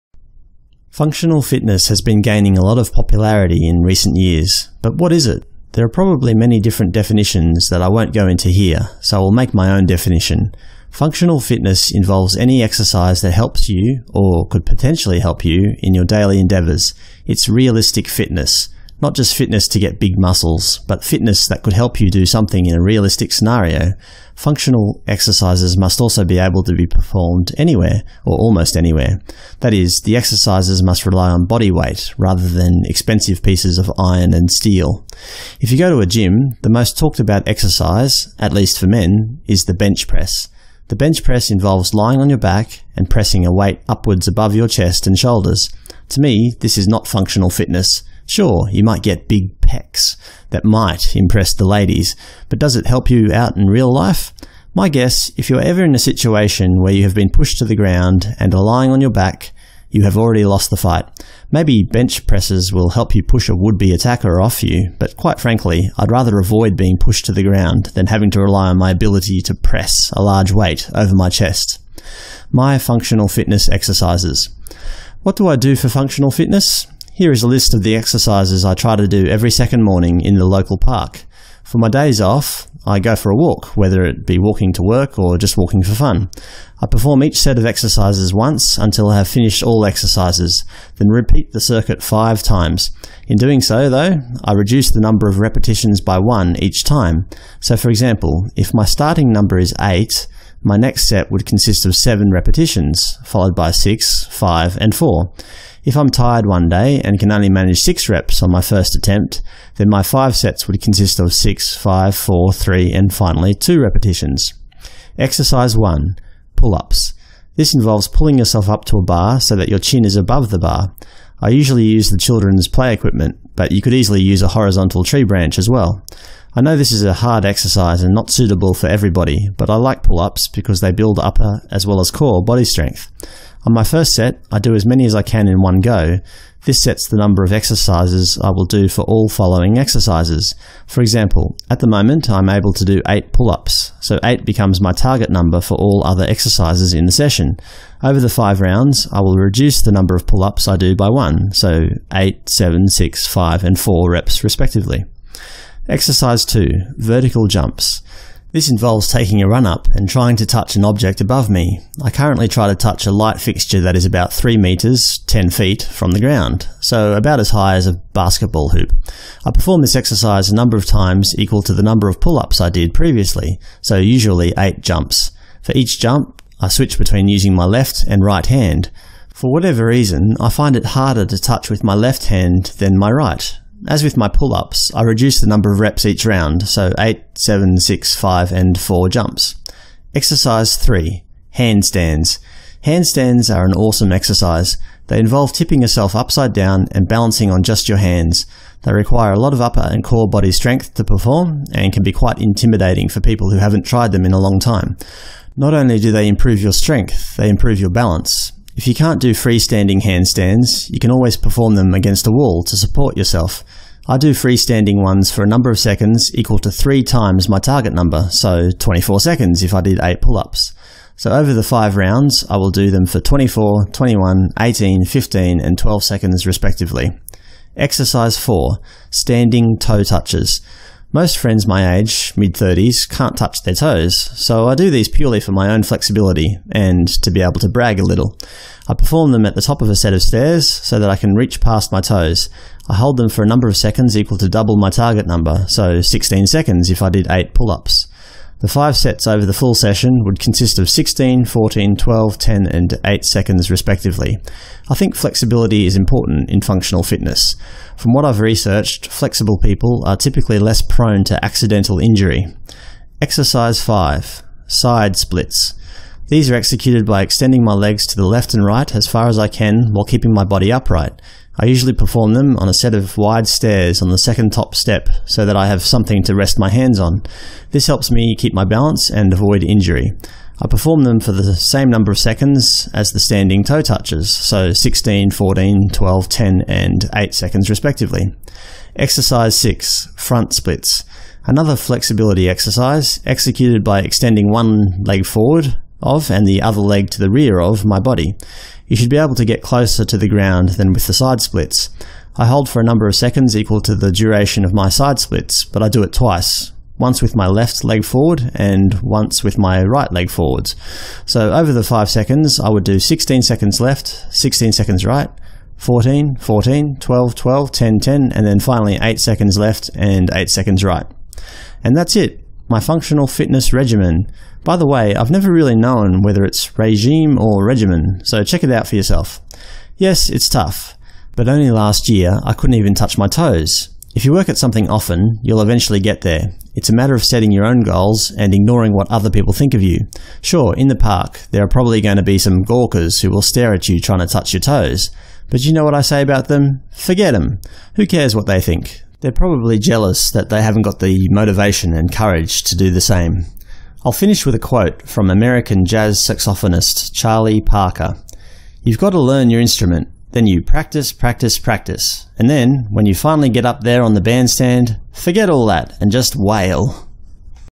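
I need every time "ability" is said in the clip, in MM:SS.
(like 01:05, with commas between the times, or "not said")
01:08.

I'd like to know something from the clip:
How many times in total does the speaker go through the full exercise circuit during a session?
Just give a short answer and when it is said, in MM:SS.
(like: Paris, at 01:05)
5, at 01:32.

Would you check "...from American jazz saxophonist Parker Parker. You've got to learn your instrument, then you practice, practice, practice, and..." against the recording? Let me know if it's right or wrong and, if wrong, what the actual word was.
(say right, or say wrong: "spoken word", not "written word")
wrong: "Charlie", not "Parker".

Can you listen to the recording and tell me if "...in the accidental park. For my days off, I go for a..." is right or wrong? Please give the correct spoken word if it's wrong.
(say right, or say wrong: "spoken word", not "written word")
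wrong: "local", not "accidental".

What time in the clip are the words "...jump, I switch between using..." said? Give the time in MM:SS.
02:55.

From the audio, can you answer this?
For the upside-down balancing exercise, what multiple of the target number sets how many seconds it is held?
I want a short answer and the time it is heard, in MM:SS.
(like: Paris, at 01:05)
3 times, at 03:36.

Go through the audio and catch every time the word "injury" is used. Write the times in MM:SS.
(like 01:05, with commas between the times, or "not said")
04:21, 04:39.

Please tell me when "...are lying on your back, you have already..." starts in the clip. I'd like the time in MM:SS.
00:58.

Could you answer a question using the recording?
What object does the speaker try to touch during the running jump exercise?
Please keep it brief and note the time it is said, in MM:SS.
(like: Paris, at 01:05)
a light fixture, at 02:43.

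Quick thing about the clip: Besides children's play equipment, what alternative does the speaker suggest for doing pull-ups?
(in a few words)
horizontal tree branch.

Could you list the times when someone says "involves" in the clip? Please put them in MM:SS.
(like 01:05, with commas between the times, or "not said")
00:11, 00:41, 01:57, 02:38, 03:15.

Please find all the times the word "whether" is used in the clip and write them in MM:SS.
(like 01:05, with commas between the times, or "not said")
01:23, 05:26.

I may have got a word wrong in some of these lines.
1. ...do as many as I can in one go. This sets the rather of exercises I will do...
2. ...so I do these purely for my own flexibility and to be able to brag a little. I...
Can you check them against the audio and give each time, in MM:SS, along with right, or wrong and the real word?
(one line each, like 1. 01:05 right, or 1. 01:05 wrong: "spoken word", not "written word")
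1. 02:14 wrong: "number", not "rather"
2. 03:54 right.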